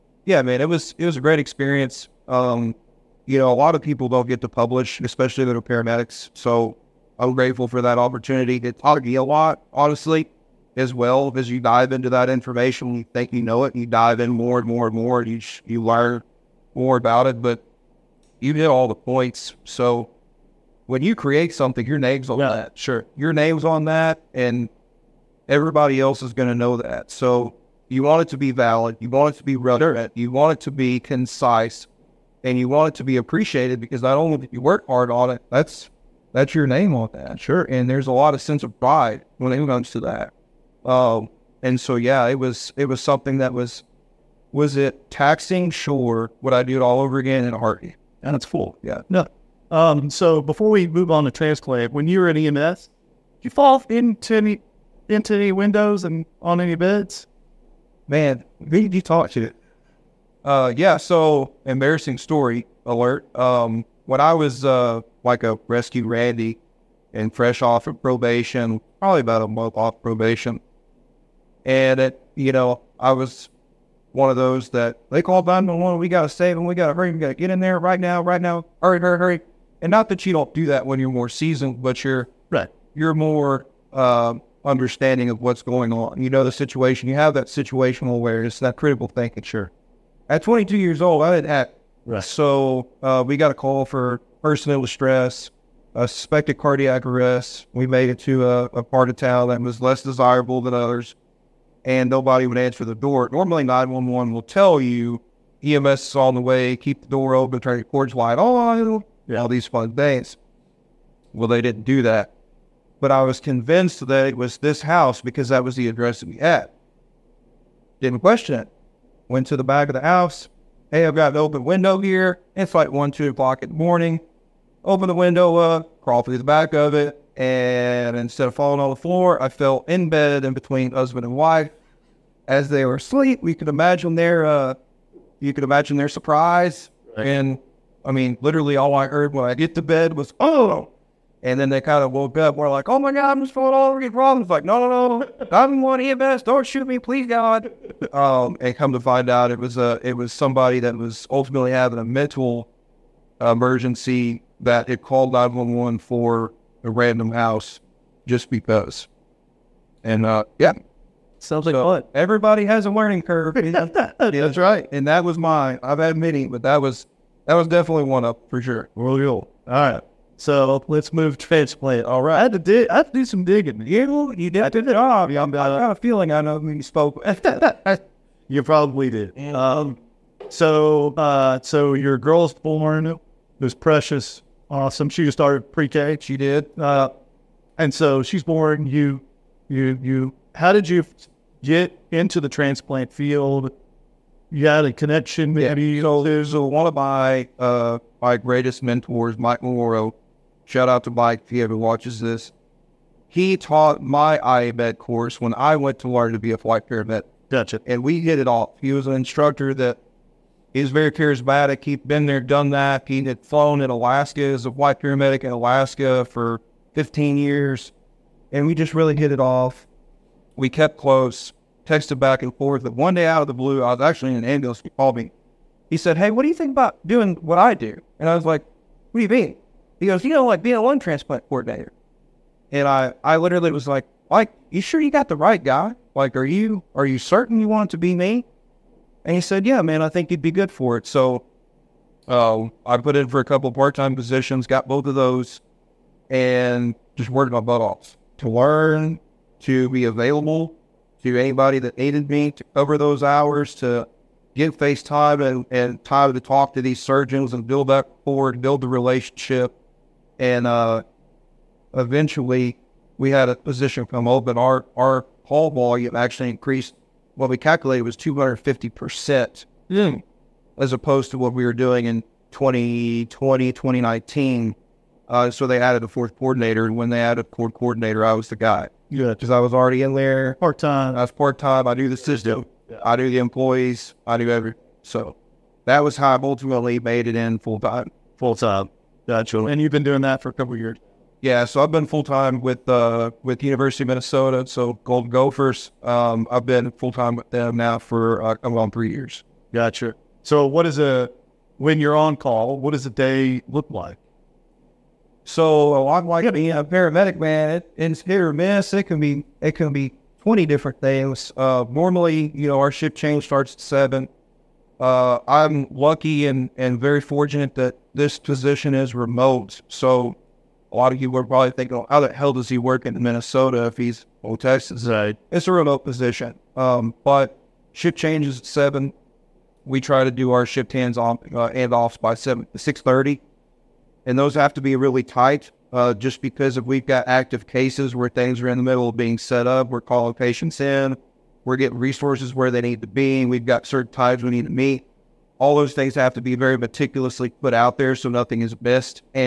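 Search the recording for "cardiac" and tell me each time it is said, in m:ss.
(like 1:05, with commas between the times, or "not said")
1:36.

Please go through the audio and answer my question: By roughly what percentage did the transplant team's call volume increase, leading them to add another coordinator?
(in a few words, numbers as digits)
250%.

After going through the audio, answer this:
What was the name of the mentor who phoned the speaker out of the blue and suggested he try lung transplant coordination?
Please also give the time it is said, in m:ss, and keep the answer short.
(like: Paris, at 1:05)
Mike Moro, at 3:19.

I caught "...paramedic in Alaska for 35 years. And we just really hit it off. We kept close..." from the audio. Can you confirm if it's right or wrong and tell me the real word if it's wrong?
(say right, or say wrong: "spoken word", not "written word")
wrong: "15", not "35".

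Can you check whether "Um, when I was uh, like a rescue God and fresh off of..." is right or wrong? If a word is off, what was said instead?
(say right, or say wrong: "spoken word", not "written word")
wrong: "Randy", not "God".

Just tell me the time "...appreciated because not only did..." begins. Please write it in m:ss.
0:33.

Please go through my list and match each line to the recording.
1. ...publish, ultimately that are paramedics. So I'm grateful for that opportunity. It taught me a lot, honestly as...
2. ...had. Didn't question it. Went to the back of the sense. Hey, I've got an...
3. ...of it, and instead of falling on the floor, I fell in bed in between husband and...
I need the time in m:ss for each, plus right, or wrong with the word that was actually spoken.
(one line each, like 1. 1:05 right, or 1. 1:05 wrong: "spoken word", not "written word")
1. 0:04 wrong: "especially", not "ultimately"
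2. 1:56 wrong: "house", not "sense"
3. 2:06 right.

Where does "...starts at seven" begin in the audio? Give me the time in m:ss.
5:13.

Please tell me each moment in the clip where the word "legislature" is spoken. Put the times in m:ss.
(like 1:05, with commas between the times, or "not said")
not said.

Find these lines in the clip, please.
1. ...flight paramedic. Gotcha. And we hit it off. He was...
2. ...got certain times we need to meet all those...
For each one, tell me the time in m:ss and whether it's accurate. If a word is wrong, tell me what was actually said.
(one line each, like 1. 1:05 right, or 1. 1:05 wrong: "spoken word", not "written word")
1. 3:26 right
2. 5:43 right.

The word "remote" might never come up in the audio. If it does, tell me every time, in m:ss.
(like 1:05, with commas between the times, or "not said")
5:19, 5:25.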